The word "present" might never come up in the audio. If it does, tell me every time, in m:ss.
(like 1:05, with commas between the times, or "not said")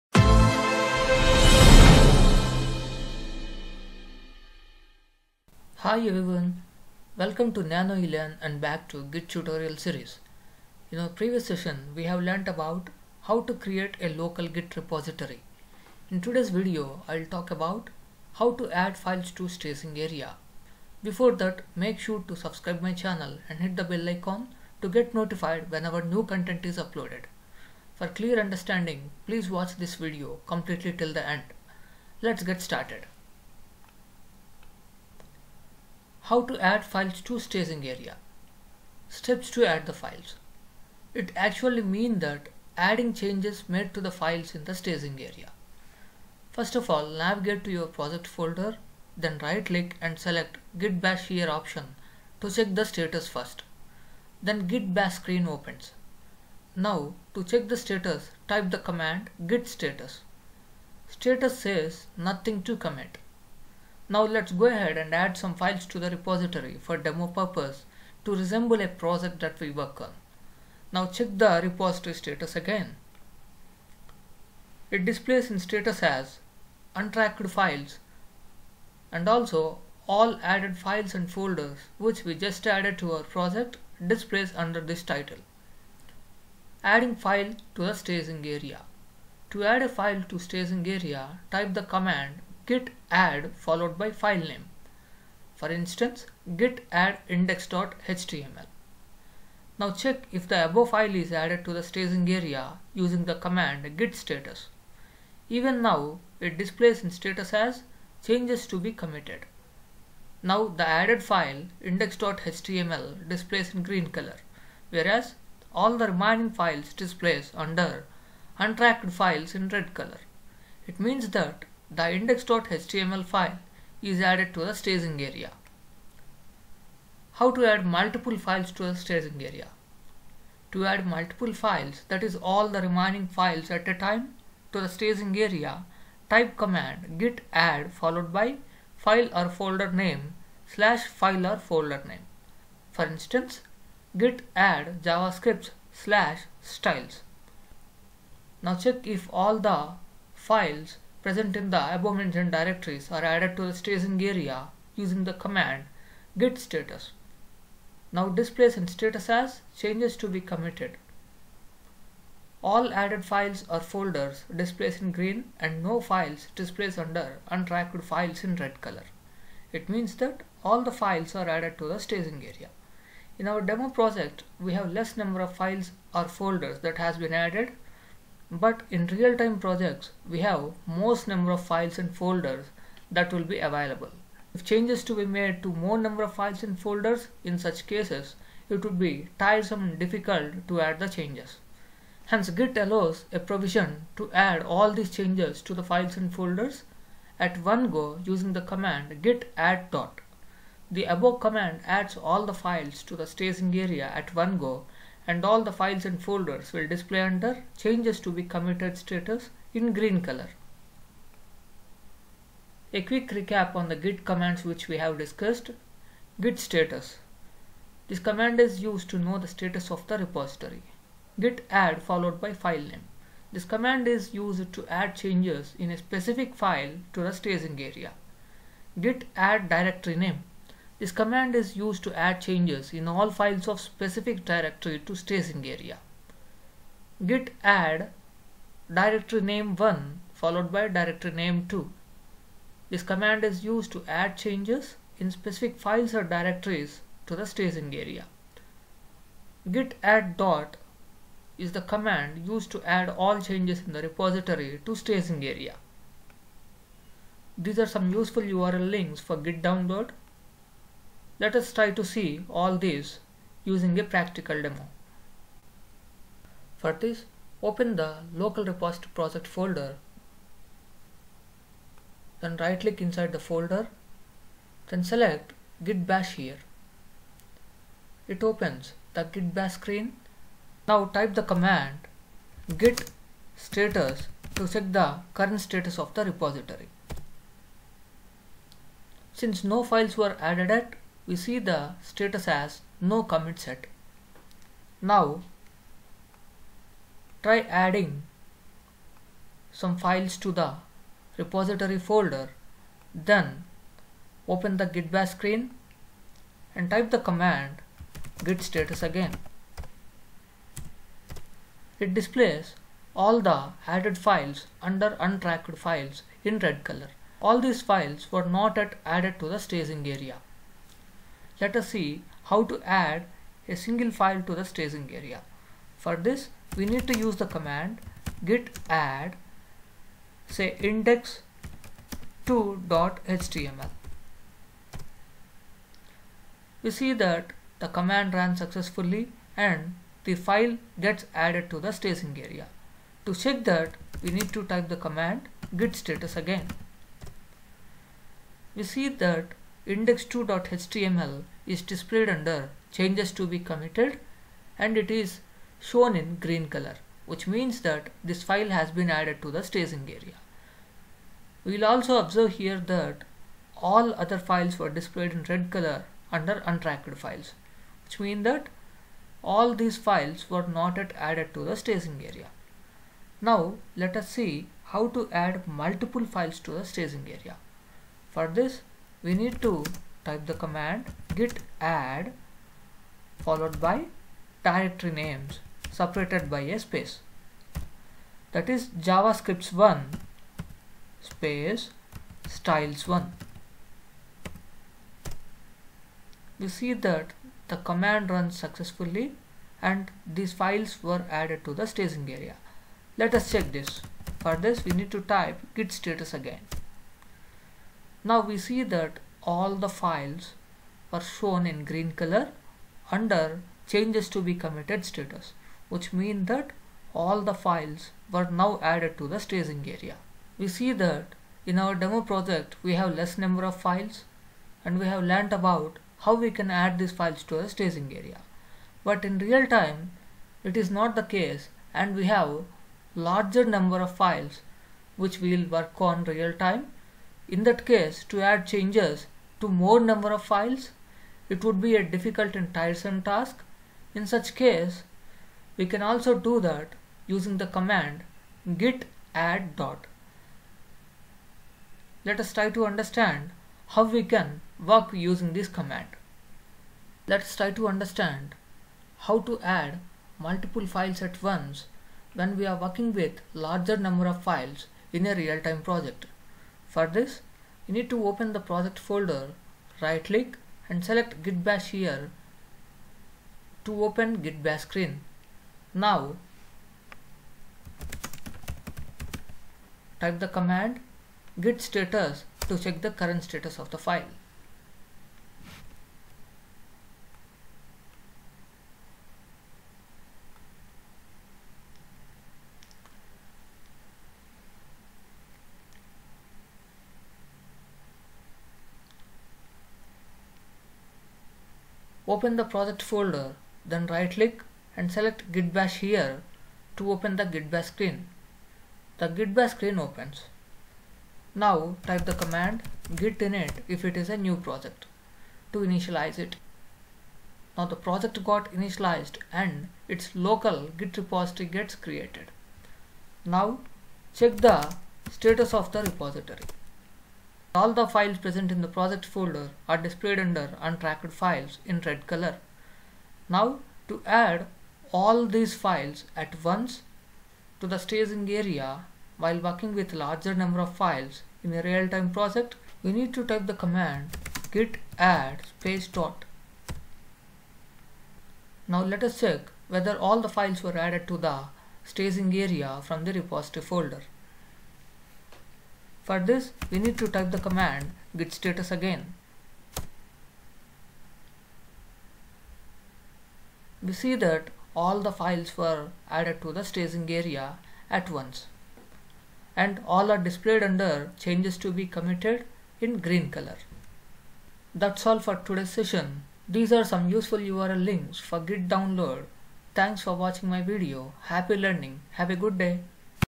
2:31, 8:48.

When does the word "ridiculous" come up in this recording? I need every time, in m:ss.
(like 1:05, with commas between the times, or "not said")
not said.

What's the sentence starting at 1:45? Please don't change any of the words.
Even now, it displays in status as changes to be committed.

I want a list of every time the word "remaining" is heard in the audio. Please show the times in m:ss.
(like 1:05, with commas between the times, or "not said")
1:56, 2:12.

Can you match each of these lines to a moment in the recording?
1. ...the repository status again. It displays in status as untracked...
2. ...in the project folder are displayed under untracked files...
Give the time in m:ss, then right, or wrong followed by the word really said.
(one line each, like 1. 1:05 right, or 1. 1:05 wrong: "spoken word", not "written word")
1. 1:11 right
2. 8:48 right.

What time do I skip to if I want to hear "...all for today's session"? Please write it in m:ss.
9:35.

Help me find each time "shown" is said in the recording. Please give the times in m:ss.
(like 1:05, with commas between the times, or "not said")
5:55, 6:51.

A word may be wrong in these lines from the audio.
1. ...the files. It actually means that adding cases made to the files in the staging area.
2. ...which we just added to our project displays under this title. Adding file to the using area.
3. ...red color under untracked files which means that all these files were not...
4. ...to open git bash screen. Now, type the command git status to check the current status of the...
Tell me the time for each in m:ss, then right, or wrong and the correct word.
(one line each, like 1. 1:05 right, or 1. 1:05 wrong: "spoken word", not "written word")
1. 0:39 wrong: "changes", not "cases"
2. 1:21 wrong: "staging", not "using"
3. 6:05 right
4. 7:53 right.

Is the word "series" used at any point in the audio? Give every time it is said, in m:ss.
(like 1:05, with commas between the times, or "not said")
0:09.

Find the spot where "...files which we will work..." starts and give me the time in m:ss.
7:14.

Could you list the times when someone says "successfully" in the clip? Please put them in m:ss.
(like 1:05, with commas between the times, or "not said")
5:38, 6:38.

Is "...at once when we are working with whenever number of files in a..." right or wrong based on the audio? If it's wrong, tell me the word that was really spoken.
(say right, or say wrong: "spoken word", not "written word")
wrong: "larger", not "whenever".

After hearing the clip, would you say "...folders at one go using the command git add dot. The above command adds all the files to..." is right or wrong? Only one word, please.
right.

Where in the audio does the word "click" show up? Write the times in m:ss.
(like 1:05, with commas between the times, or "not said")
0:49, 4:32, 7:50, 8:24.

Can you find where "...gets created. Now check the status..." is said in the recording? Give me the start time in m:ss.
8:41.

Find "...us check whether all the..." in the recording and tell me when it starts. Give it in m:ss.
9:09.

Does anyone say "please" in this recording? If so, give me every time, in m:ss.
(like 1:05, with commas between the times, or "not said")
0:29.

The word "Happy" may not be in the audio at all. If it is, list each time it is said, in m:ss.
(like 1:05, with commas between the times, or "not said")
9:41.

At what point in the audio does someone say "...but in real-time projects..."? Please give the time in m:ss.
2:58.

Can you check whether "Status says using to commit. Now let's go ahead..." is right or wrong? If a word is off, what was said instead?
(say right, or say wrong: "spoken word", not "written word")
wrong: "nothing", not "using".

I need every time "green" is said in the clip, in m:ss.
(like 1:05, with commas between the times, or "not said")
1:53, 2:45, 3:29, 5:56, 6:51, 9:33.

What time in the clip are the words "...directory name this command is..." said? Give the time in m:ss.
3:49.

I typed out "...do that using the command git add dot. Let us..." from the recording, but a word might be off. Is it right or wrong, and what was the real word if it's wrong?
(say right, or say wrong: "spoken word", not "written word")
right.